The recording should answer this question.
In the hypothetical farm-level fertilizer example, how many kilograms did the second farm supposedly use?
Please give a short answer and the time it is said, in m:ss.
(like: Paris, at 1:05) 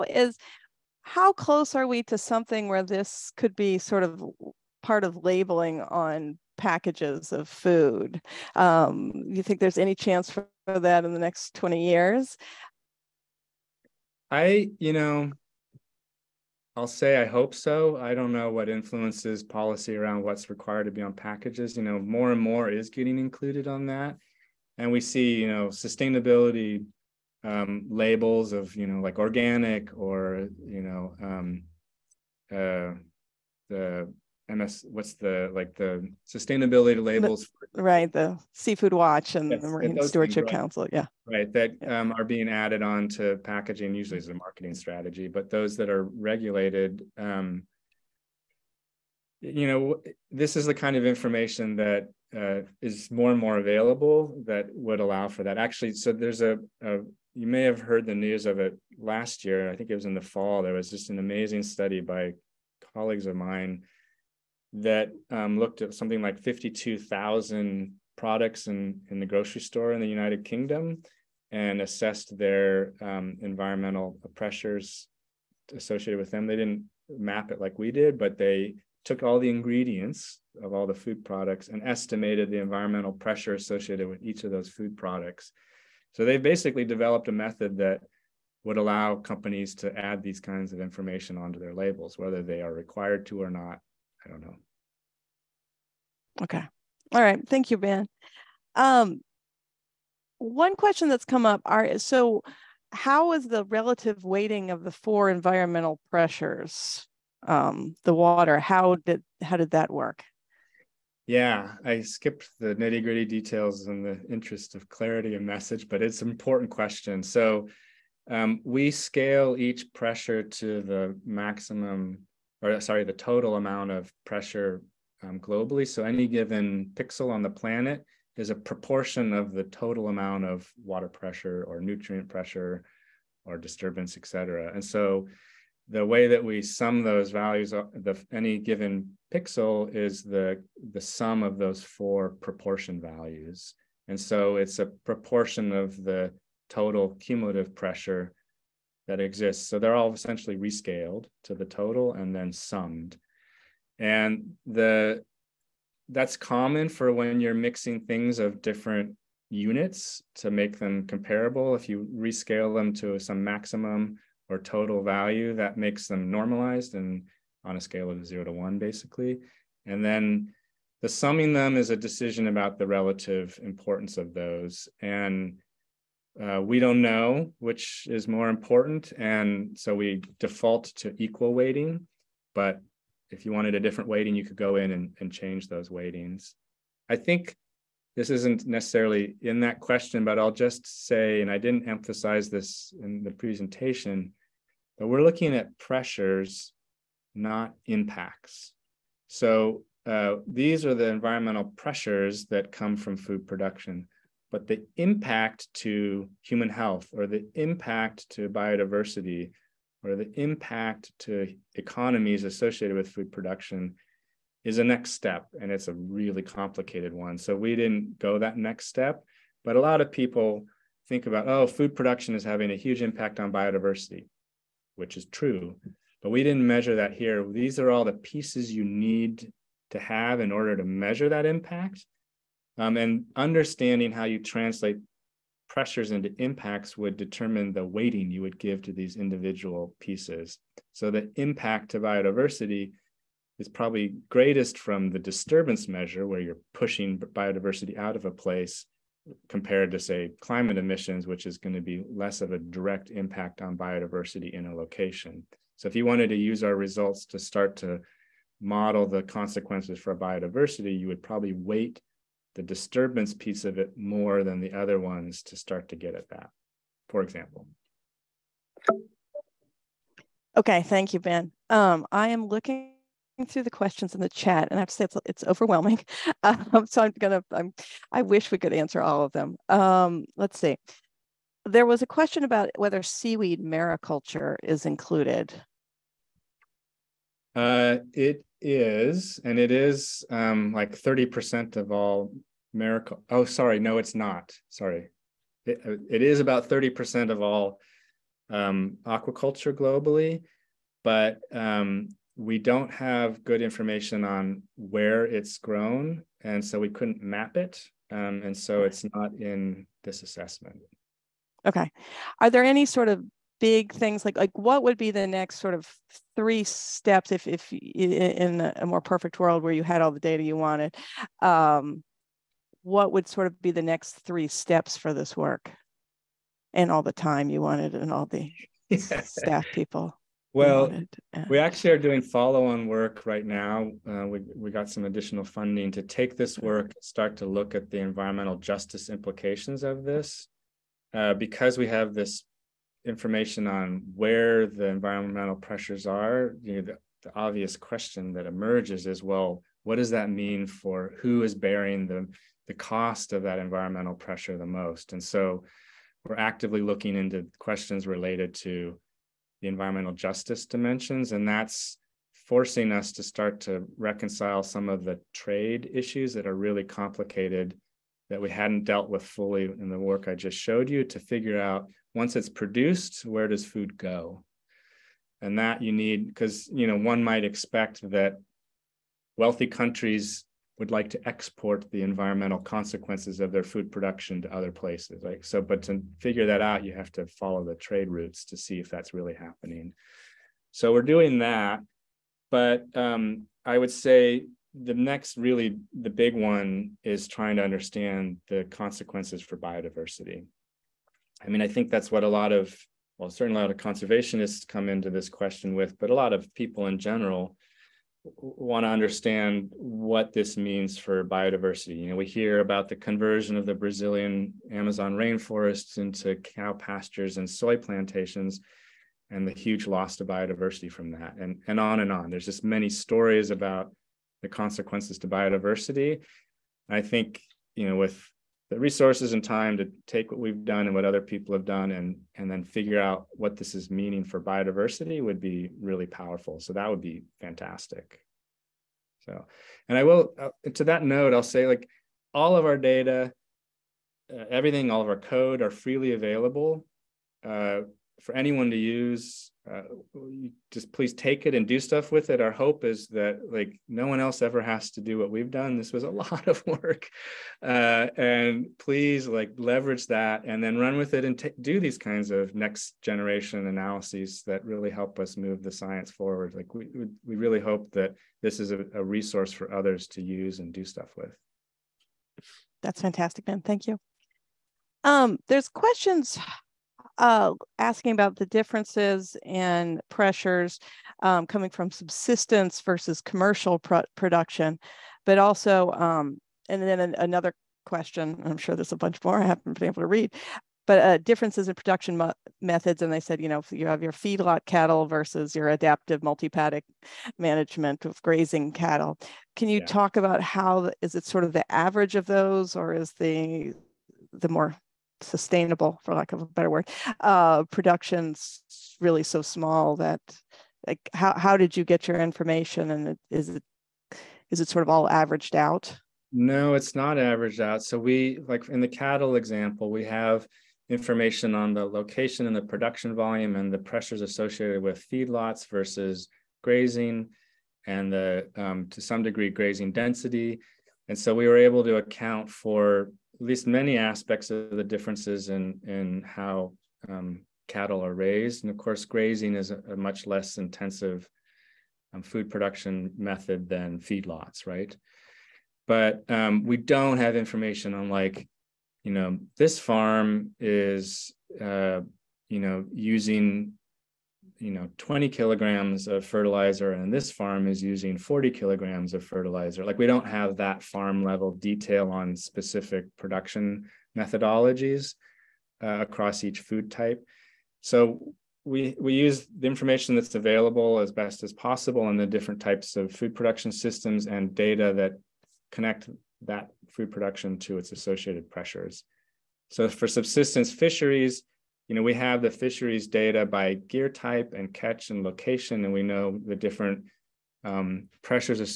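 40 kilograms, at 9:18.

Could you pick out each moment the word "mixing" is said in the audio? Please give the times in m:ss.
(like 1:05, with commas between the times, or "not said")
2:37.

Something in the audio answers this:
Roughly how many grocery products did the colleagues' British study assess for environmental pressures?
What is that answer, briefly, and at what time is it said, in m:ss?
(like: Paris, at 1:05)
52,000, at 1:06.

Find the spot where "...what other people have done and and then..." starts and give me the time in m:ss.
7:10.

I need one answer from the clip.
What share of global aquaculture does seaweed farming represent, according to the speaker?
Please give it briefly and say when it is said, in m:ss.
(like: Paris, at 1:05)
30%, at 4:56.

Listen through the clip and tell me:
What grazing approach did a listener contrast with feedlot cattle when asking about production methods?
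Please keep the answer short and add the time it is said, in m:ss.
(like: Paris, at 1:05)
adaptive multi-paddock management, at 8:15.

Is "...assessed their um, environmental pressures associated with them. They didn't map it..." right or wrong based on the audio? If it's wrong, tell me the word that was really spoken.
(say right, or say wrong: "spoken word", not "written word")
right.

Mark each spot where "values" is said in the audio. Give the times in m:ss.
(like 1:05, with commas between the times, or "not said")
2:17, 2:23, 2:45.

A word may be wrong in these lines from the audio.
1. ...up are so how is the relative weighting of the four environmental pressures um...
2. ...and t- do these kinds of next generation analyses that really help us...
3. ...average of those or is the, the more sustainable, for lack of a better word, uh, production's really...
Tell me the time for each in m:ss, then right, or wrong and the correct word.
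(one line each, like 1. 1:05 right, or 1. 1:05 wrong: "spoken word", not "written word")
1. 1:41 right
2. 7:41 right
3. 8:21 right.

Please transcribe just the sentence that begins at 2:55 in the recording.
And uh, we don't know which is more important.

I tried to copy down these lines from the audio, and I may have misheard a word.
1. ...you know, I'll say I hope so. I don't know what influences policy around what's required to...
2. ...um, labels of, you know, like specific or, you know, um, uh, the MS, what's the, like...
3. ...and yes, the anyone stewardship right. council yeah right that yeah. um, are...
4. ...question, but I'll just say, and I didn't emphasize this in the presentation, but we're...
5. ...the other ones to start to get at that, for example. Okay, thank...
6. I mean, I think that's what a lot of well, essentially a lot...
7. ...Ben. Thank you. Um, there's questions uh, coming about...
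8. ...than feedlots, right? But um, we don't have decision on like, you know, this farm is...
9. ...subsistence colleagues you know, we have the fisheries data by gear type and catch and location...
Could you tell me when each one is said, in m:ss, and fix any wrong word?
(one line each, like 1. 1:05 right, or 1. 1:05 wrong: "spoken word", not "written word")
1. 0:14 right
2. 0:27 wrong: "organic", not "specific"
3. 0:39 wrong: "marine", not "anyone"
4. 3:09 right
5. 4:24 right
6. 6:41 wrong: "certainly", not "essentially"
7. 7:53 wrong: "asking", not "coming"
8. 9:03 wrong: "information", not "decision"
9. 9:40 wrong: "fisheries", not "colleagues".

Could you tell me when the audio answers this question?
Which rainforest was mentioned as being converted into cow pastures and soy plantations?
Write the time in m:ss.
6:53.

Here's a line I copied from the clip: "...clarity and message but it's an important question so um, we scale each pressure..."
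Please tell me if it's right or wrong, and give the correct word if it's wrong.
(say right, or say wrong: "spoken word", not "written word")
right.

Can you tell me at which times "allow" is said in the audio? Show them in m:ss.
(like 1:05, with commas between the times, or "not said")
0:55, 1:28.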